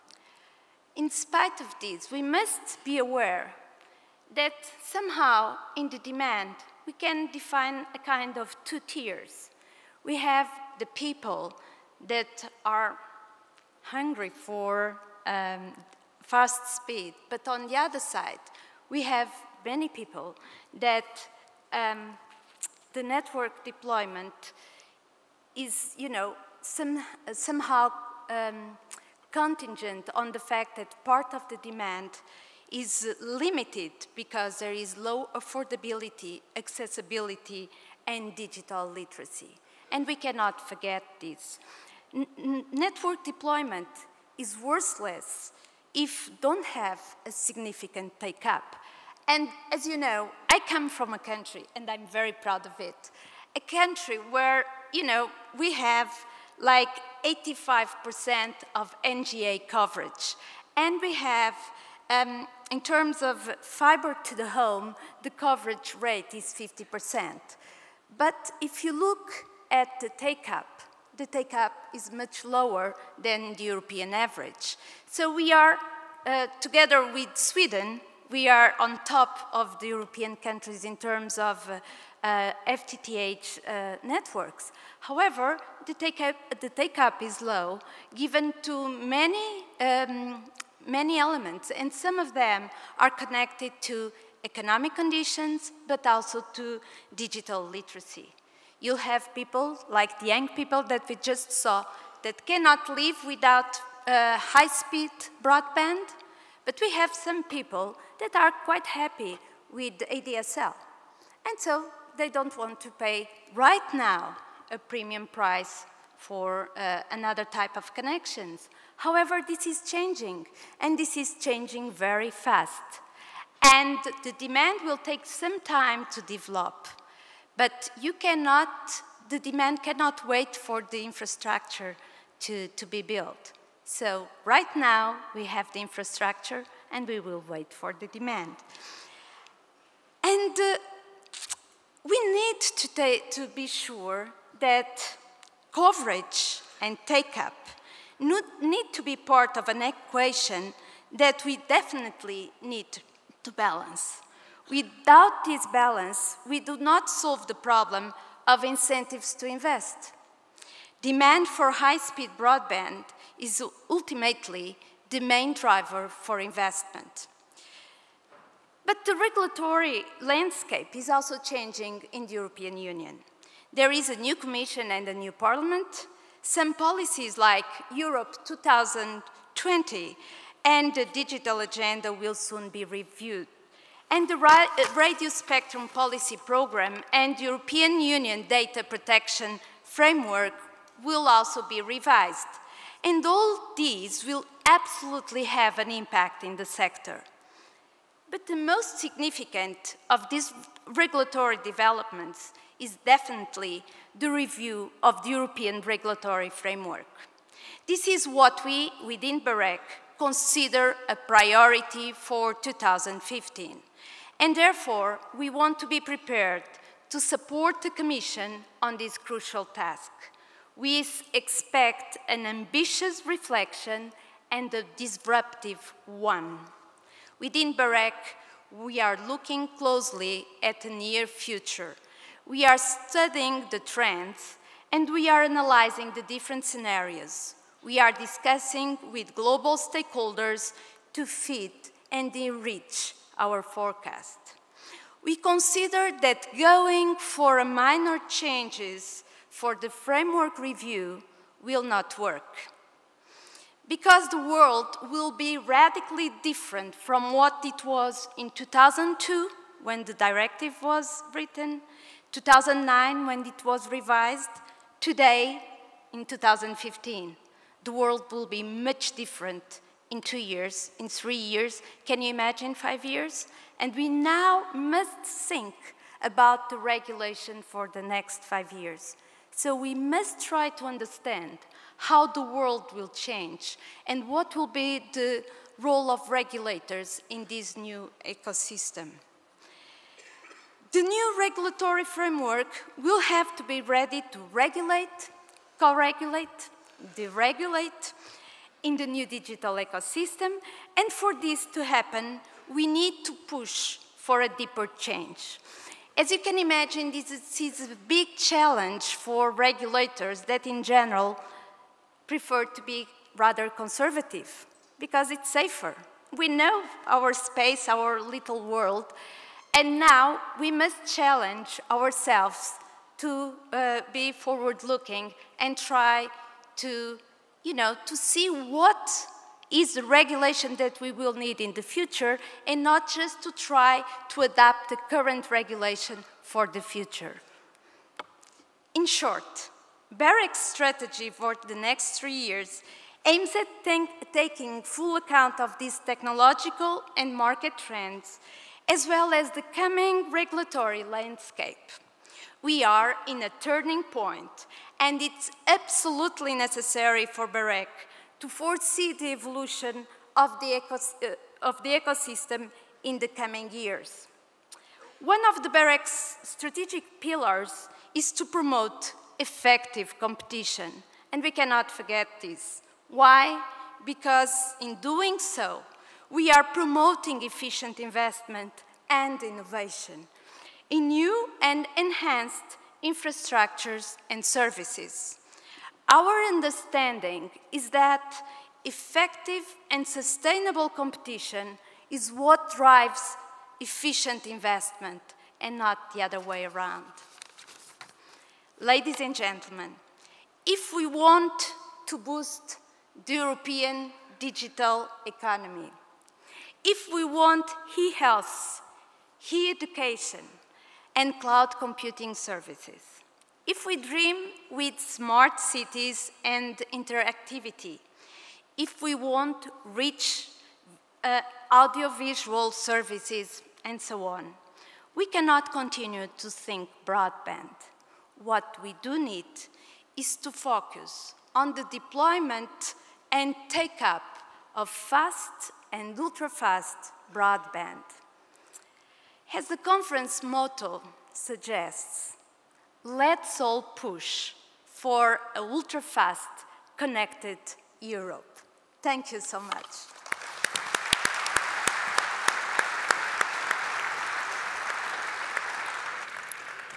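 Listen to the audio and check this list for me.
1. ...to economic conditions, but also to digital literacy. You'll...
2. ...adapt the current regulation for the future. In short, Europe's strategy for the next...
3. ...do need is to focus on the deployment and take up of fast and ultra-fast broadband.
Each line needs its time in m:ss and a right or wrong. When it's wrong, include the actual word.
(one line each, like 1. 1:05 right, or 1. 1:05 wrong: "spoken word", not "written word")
1. 1:33 right
2. 5:34 wrong: "BEREC", not "Europe"
3. 7:09 right.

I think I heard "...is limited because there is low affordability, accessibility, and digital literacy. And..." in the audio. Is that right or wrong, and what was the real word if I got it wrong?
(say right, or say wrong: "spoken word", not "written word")
right.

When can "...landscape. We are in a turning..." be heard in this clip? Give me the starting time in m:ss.
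5:51.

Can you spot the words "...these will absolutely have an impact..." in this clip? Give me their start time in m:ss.
3:13.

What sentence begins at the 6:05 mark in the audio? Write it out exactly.
One of the BEREC's strategic pillars is to promote effective competition, and we cannot forget this.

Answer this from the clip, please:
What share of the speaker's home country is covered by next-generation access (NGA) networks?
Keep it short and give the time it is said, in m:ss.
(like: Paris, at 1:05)
85%, at 0:57.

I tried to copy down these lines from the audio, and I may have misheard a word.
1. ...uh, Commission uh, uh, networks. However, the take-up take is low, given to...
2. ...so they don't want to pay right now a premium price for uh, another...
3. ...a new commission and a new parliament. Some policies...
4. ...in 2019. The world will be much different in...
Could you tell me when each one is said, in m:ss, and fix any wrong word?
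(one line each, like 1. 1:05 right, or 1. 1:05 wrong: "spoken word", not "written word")
1. 1:22 wrong: "FTTH", not "Commission"
2. 1:51 right
3. 2:54 right
4. 4:26 wrong: "2015", not "2019".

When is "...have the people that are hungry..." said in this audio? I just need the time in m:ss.
0:10.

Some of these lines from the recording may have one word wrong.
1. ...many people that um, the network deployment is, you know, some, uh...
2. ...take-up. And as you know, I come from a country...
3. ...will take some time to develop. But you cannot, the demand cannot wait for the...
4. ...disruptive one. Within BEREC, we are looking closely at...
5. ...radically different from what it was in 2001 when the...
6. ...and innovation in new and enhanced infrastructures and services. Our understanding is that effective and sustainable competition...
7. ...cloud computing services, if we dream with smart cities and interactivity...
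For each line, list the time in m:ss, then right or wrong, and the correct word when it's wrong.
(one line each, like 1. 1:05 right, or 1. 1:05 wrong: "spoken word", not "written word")
1. 0:19 right
2. 0:48 right
3. 2:04 right
4. 3:44 right
5. 4:15 wrong: "2002", not "2001"
6. 6:19 right
7. 6:51 right.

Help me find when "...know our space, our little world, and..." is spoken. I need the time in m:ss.
5:16.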